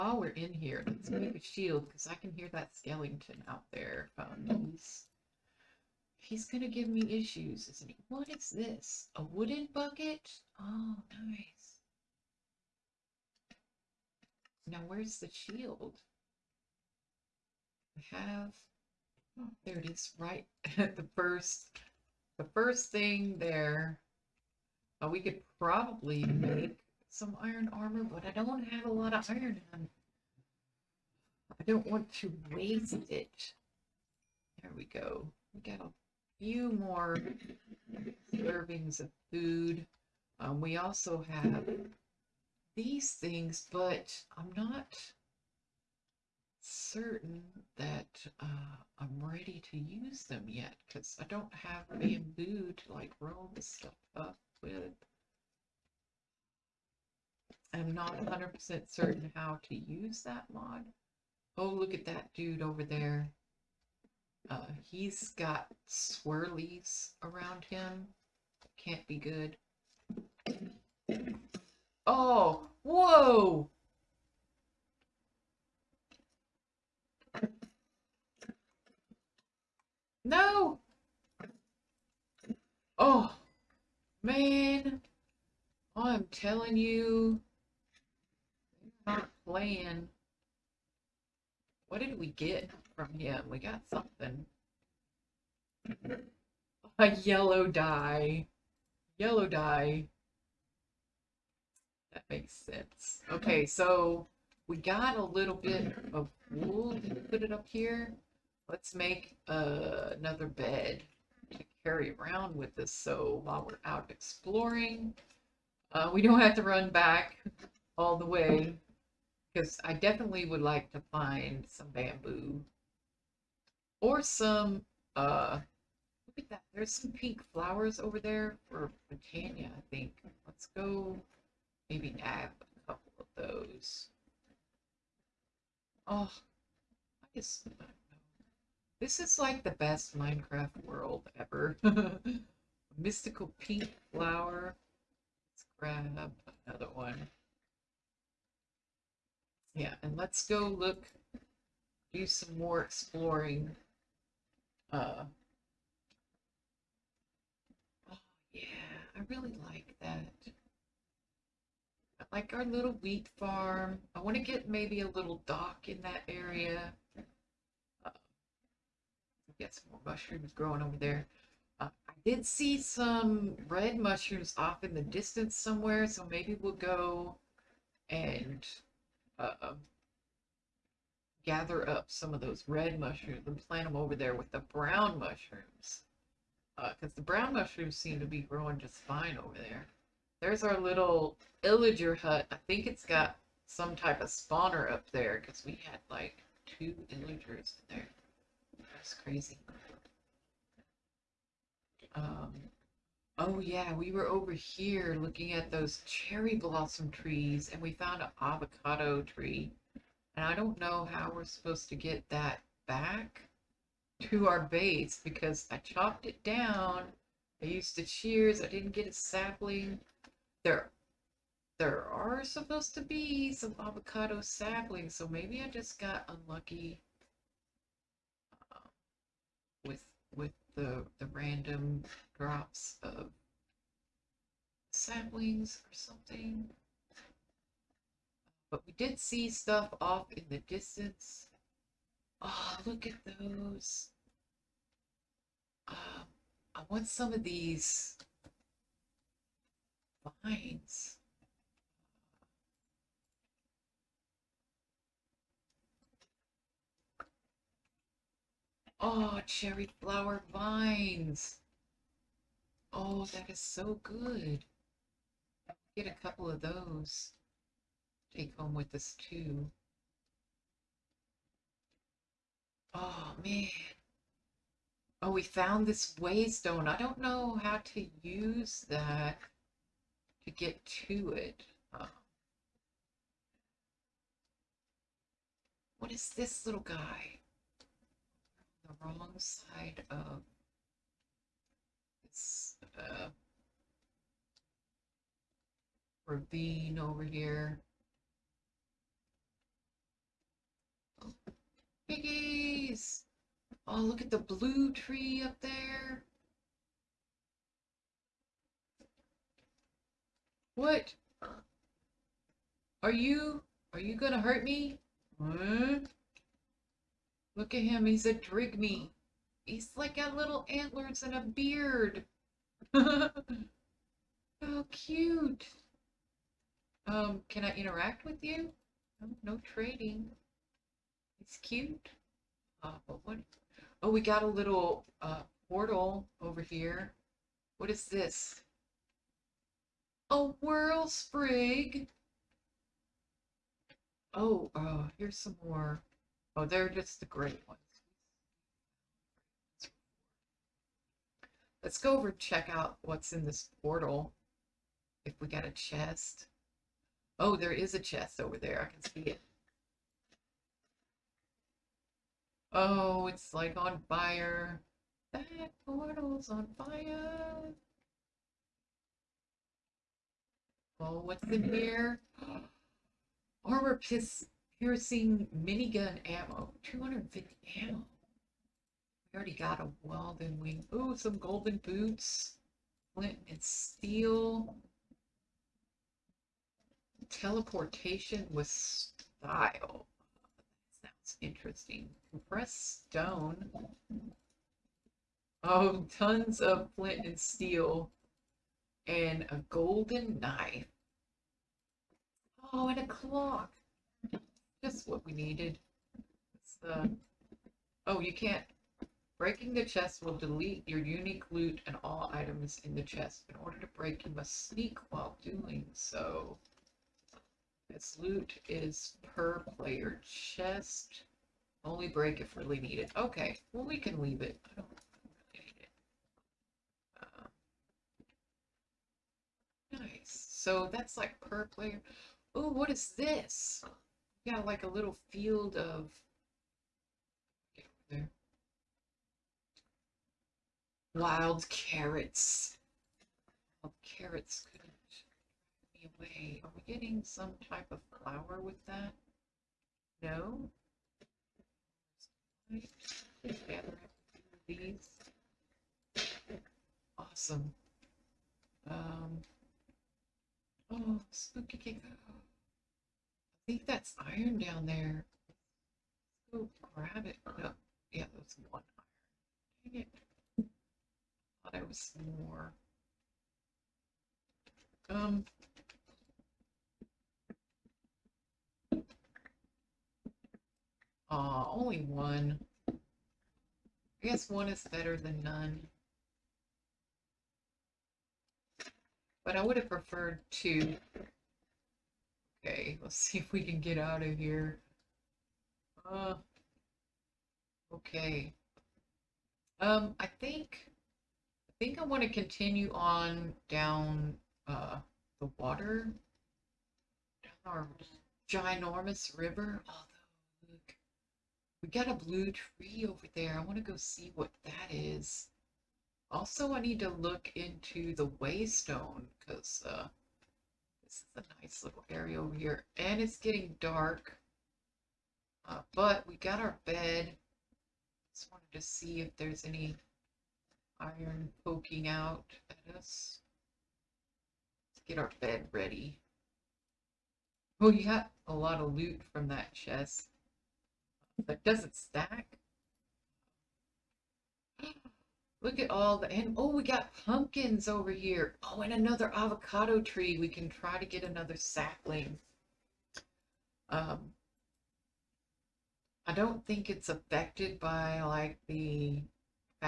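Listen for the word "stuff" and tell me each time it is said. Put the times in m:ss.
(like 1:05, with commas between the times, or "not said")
0:53, 3:59.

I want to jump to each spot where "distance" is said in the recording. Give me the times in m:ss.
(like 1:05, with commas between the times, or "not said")
2:55, 4:00.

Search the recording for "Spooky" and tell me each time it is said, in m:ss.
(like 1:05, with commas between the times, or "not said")
7:41.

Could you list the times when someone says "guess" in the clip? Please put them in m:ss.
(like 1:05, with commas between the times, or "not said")
2:17, 8:04.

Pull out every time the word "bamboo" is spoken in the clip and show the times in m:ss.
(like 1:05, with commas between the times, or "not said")
0:51, 2:01.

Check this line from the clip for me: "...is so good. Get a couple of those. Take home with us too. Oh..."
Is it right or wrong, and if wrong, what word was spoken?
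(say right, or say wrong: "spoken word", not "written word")
right.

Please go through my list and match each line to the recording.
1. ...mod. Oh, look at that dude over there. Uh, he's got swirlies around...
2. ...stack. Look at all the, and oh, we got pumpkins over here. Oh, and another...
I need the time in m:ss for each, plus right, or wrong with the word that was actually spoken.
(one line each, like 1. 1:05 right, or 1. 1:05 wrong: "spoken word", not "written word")
1. 1:00 right
2. 9:01 right.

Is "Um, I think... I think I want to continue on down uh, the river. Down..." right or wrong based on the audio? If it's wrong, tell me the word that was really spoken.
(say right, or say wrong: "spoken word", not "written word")
wrong: "water", not "river".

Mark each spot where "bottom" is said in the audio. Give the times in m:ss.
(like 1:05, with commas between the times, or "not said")
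not said.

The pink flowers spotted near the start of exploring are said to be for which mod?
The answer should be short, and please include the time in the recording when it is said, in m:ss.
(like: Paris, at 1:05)
Botania, at 2:09.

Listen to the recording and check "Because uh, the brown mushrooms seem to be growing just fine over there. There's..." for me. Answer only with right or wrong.
right.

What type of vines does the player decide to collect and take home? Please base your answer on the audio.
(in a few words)
Cherry flower vines.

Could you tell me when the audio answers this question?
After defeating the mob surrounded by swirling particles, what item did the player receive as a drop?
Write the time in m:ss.
1:36.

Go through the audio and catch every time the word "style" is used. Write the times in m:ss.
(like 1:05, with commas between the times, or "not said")
6:28.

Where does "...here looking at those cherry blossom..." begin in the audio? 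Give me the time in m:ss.
3:24.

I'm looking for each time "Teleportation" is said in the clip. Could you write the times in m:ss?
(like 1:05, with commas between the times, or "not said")
6:27.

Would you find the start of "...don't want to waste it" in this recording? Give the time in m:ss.
0:31.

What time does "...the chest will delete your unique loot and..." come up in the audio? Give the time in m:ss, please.
6:49.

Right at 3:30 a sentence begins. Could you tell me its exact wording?
And I don't know how we're supposed to get that back to our base because I chopped it down.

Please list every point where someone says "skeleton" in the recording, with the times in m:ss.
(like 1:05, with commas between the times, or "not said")
0:02.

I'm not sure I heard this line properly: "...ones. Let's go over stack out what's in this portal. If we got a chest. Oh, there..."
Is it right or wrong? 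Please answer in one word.
wrong.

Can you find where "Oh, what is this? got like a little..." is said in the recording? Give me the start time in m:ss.
7:12.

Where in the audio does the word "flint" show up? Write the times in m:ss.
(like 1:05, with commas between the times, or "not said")
6:23, 6:36.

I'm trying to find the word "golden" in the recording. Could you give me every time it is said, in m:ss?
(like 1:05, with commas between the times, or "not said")
6:21, 6:39.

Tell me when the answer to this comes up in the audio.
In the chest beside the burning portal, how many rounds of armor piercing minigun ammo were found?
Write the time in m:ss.
6:16.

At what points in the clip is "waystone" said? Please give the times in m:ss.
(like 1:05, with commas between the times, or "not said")
4:36, 8:38.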